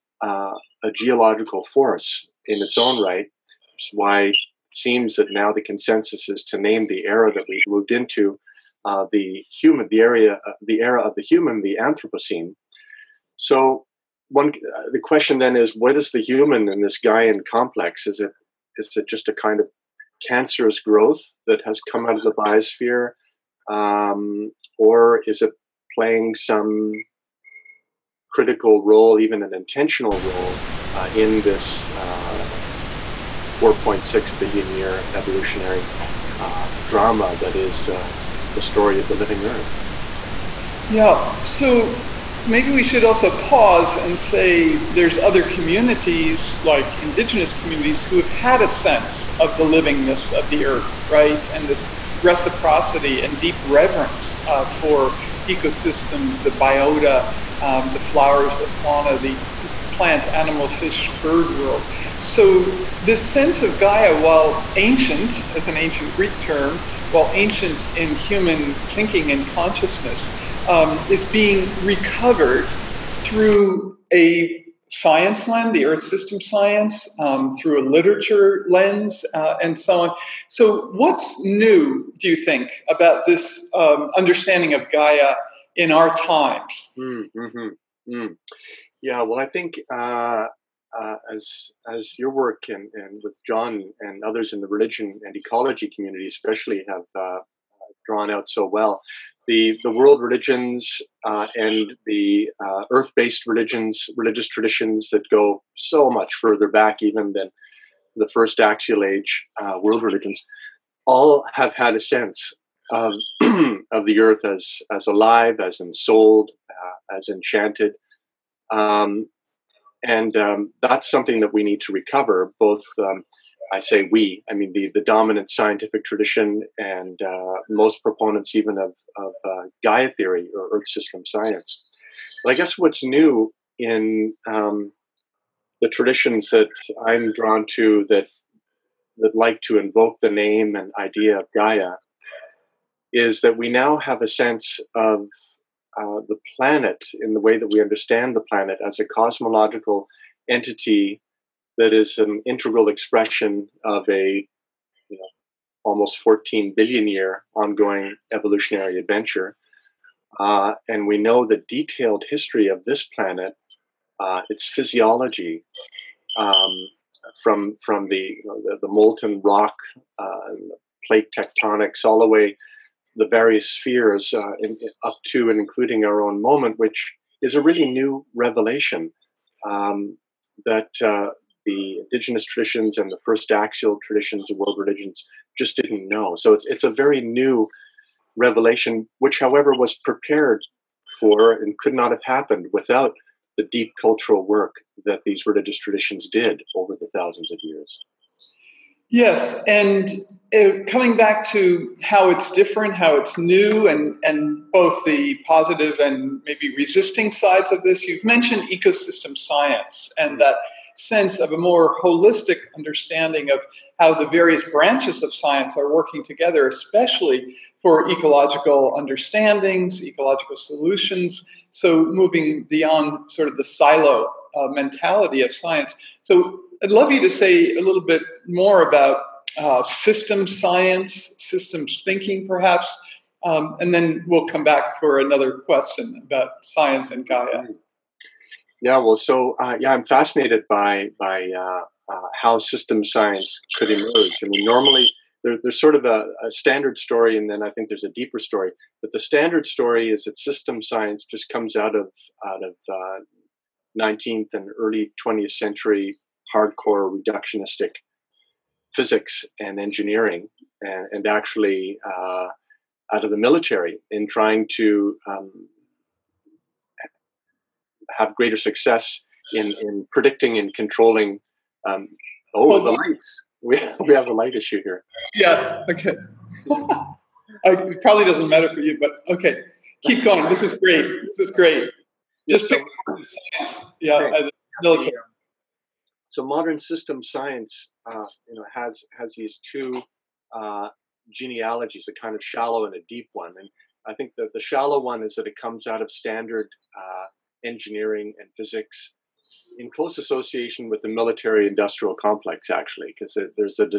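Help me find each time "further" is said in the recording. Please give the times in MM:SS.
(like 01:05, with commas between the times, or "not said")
01:46.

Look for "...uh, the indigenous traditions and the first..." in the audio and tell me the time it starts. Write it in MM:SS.
03:01.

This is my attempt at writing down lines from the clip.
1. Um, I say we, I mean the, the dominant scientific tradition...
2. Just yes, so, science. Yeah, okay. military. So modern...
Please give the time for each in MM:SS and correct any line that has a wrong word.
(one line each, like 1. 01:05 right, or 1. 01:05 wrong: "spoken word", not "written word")
1. 02:02 right
2. 04:42 right.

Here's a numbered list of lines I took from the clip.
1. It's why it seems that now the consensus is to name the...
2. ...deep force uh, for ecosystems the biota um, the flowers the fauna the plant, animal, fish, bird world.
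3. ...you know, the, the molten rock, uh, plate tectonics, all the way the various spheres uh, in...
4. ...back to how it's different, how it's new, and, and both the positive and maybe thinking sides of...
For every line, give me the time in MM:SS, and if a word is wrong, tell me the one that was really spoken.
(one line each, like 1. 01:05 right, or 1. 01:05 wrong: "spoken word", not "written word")
1. 00:03 right
2. 00:53 wrong: "reverence", not "force"
3. 02:48 right
4. 03:21 wrong: "resisting", not "thinking".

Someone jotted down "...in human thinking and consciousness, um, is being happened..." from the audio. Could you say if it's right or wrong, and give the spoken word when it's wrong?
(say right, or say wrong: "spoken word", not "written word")
wrong: "recovered", not "happened".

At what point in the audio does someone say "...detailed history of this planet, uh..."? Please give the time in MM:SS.
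02:41.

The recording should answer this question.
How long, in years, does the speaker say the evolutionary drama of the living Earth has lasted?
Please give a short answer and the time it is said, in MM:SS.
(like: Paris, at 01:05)
4.6 billion, at 00:33.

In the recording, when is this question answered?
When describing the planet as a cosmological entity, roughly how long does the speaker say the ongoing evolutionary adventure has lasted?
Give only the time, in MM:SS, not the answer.
02:35.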